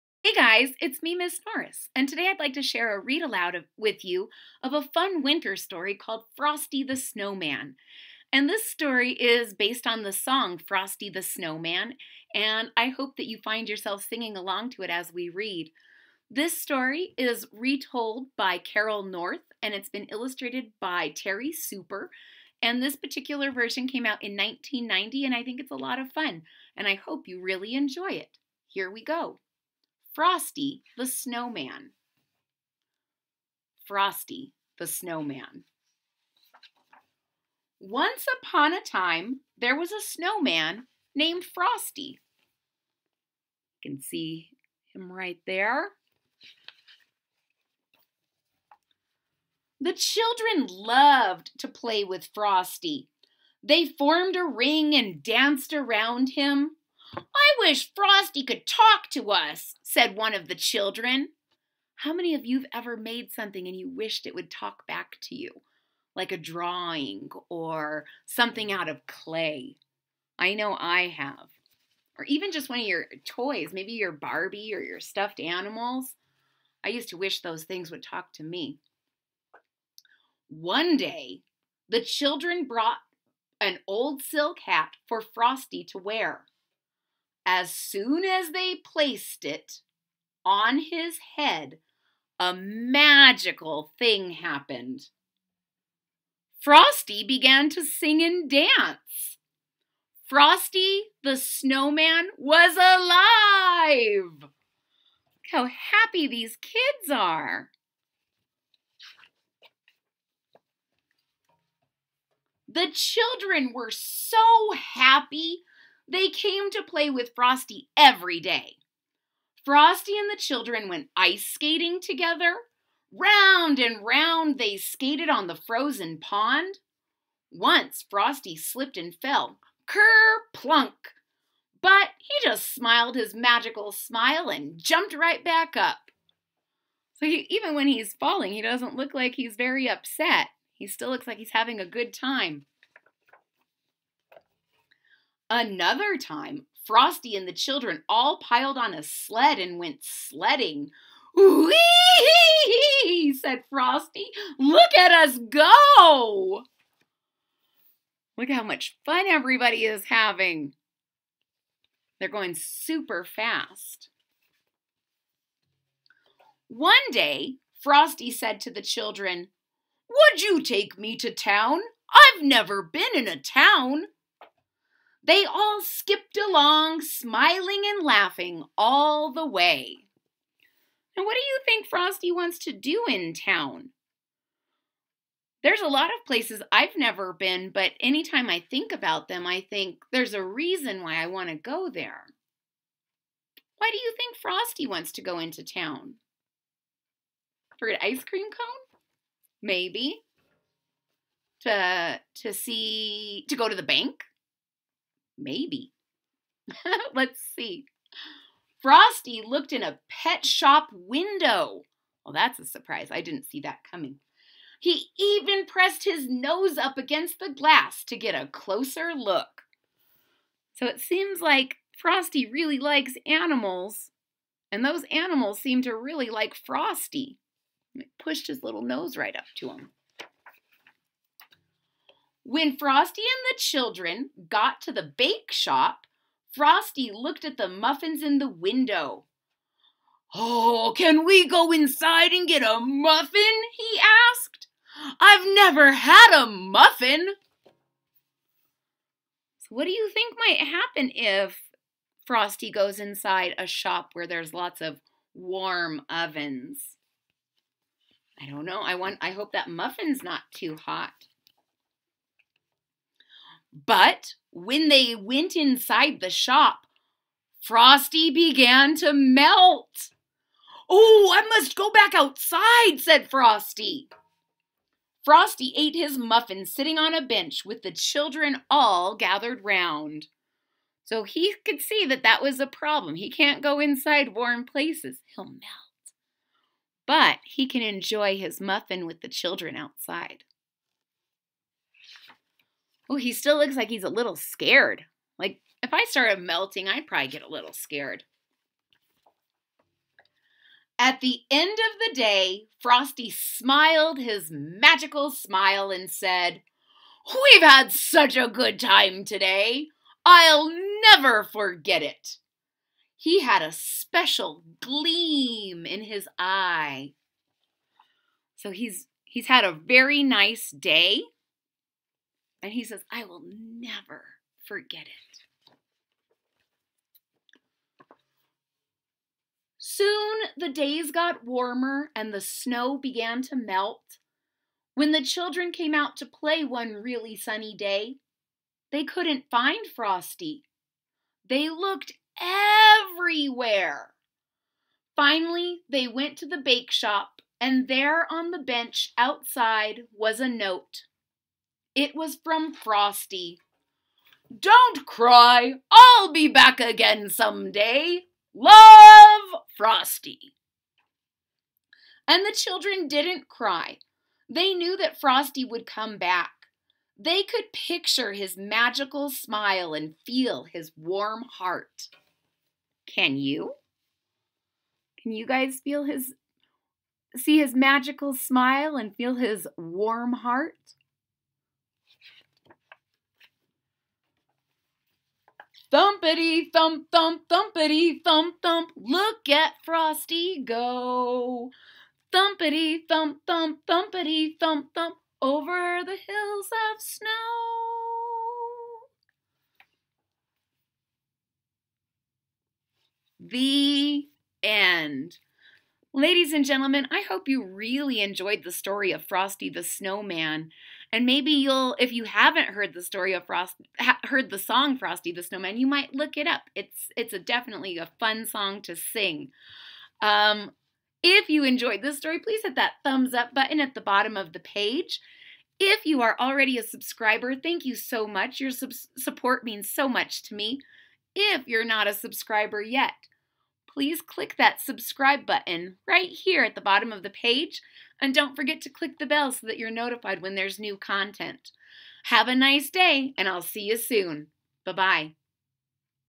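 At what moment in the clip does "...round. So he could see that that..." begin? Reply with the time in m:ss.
4:39.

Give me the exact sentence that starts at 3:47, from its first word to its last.
It pushed his little nose right up to him.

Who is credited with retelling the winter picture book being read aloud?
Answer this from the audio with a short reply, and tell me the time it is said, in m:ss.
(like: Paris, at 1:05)
Carol North, at 0:18.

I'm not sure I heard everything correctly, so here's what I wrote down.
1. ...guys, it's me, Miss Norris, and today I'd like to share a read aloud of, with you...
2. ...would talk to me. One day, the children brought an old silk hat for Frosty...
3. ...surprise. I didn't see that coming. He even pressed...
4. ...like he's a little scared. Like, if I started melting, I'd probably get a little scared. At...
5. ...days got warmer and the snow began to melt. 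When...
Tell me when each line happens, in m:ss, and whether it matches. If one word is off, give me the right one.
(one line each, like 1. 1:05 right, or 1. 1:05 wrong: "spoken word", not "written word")
1. 0:00 right
2. 1:17 right
3. 3:32 right
4. 4:53 right
5. 5:30 right.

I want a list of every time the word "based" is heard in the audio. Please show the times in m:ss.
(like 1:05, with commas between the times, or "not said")
0:09.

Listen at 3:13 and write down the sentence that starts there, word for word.
Why do you think Frosty wants to go into town?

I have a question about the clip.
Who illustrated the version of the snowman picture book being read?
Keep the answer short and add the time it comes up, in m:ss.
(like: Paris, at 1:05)
Terri Super, at 0:21.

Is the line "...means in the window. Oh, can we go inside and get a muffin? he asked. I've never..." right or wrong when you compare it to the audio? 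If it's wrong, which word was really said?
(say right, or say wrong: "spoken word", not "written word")
wrong: "muffins", not "means".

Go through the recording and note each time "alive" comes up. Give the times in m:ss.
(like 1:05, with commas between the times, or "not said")
1:42.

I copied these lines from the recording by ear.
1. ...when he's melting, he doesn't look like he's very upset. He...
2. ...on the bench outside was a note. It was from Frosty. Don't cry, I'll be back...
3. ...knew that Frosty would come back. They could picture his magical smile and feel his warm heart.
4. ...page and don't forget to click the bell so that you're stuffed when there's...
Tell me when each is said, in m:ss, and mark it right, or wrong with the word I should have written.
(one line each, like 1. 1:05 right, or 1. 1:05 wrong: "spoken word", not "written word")
1. 2:17 wrong: "falling", not "melting"
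2. 5:48 right
3. 6:04 right
4. 7:17 wrong: "notified", not "stuffed".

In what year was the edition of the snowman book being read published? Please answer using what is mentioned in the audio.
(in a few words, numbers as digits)
1990.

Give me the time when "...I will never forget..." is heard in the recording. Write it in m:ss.
5:23.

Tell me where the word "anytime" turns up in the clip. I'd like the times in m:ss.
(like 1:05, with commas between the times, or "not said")
3:07.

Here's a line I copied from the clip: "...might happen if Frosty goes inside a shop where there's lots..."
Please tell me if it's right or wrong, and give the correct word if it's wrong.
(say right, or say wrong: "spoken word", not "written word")
right.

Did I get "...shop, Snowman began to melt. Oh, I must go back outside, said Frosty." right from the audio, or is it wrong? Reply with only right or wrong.
wrong.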